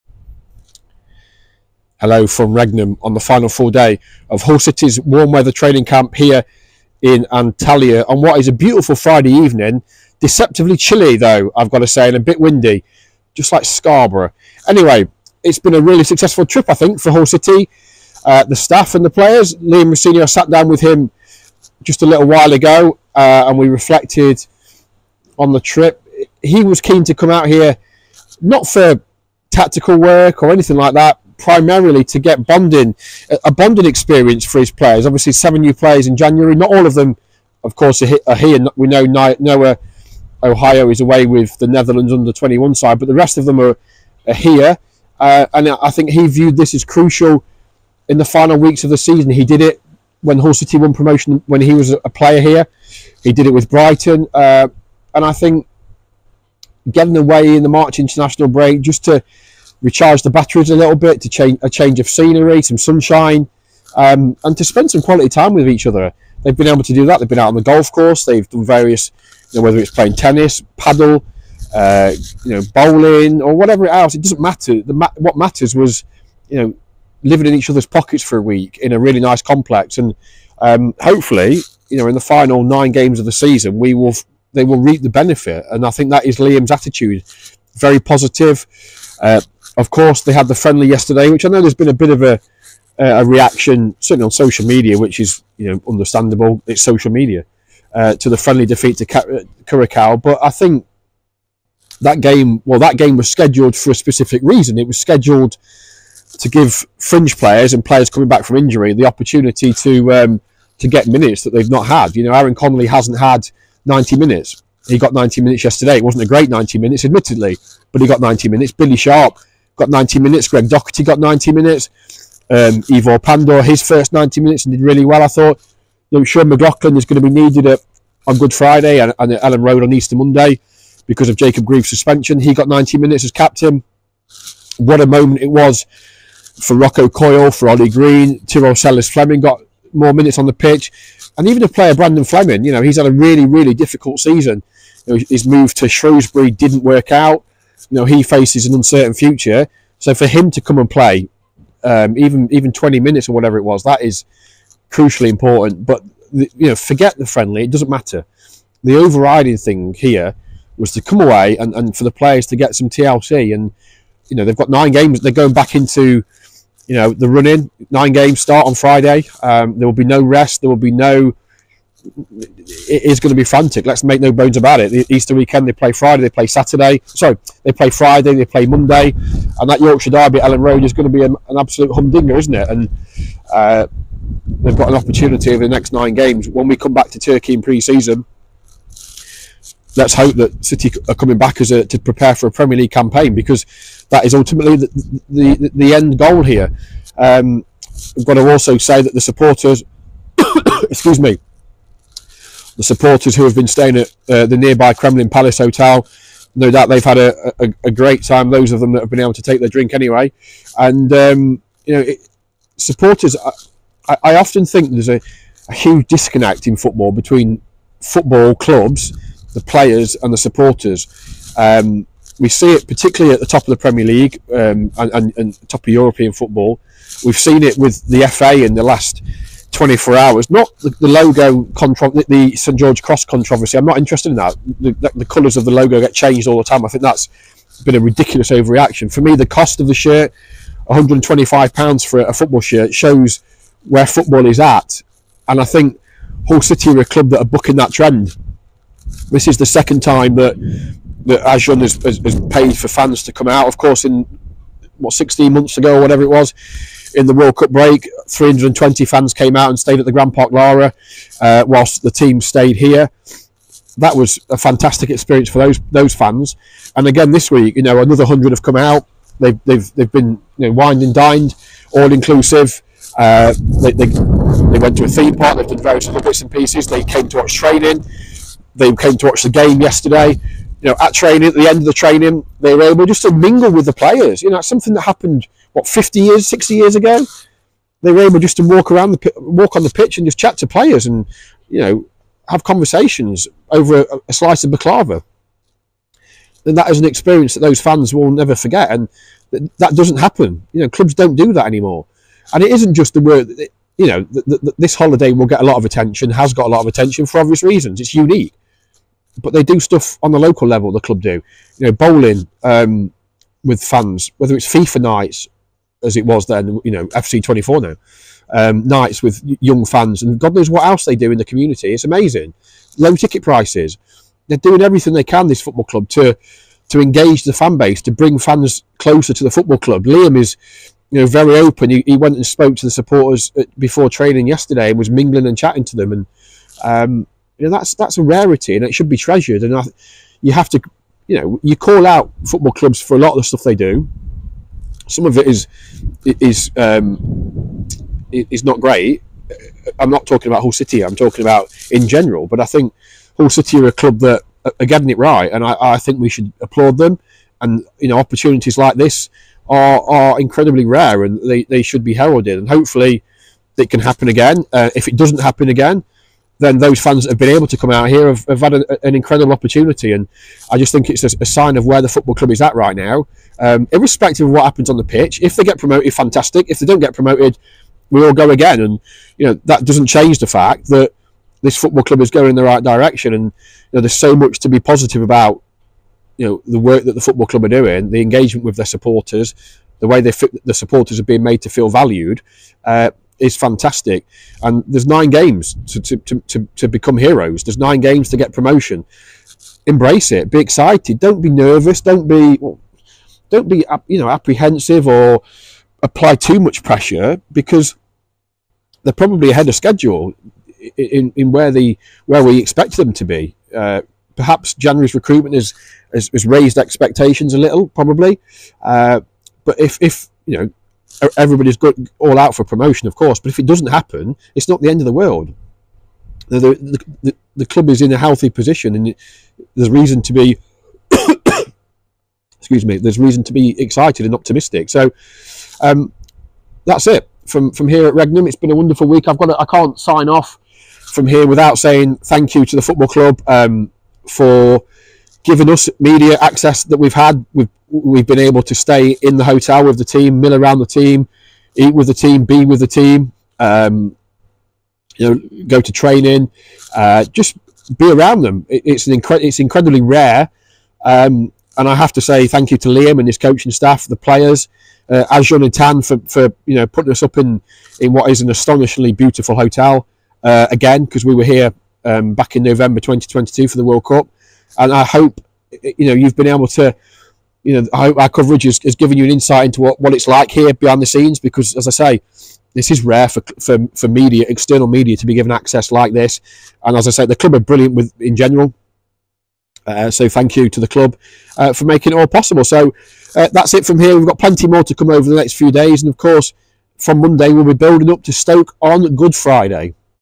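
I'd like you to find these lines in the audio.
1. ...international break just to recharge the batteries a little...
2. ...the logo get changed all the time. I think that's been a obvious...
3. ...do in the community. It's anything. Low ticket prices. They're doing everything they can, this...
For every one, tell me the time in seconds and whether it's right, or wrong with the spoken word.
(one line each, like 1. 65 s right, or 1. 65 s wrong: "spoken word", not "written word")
1. 57 s right
2. 235 s wrong: "ridiculous", not "obvious"
3. 321 s wrong: "amazing", not "anything".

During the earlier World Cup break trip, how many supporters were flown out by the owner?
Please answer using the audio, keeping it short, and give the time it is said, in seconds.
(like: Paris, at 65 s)
320, at 258 s.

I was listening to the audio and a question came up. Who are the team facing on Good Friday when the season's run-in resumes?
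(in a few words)
Stoke.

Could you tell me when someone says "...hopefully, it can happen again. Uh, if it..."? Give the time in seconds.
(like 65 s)
362 s.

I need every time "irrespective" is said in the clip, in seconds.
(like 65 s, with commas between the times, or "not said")
373 s.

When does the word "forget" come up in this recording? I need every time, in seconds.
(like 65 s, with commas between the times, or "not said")
156 s, 298 s.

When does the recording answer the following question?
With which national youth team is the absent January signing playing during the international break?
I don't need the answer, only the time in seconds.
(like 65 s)
41 s.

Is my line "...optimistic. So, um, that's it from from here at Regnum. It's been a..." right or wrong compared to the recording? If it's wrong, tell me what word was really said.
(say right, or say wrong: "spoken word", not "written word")
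right.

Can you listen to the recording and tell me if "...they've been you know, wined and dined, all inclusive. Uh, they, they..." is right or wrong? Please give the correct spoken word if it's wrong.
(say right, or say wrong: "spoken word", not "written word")
right.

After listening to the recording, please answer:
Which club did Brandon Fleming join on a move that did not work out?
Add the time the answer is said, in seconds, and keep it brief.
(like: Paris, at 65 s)
Shrewsbury, at 145 s.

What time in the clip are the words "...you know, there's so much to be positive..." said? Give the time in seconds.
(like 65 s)
383 s.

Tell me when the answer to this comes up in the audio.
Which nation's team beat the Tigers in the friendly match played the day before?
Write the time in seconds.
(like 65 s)
99 s.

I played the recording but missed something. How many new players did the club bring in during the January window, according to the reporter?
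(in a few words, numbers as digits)
7.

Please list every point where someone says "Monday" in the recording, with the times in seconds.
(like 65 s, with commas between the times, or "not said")
130 s, 178 s, 497 s.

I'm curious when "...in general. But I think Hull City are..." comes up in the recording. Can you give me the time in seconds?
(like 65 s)
351 s.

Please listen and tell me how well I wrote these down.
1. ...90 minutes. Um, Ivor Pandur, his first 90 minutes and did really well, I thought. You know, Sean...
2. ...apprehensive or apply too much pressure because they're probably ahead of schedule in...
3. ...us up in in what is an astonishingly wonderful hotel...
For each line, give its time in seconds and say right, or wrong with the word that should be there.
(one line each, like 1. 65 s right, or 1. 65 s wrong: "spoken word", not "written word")
1. 121 s right
2. 404 s right
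3. 467 s wrong: "beautiful", not "wonderful".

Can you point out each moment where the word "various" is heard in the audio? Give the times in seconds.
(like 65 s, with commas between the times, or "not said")
68 s, 275 s.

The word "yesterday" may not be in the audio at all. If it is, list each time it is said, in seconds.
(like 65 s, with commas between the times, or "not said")
90 s, 115 s, 279 s, 334 s.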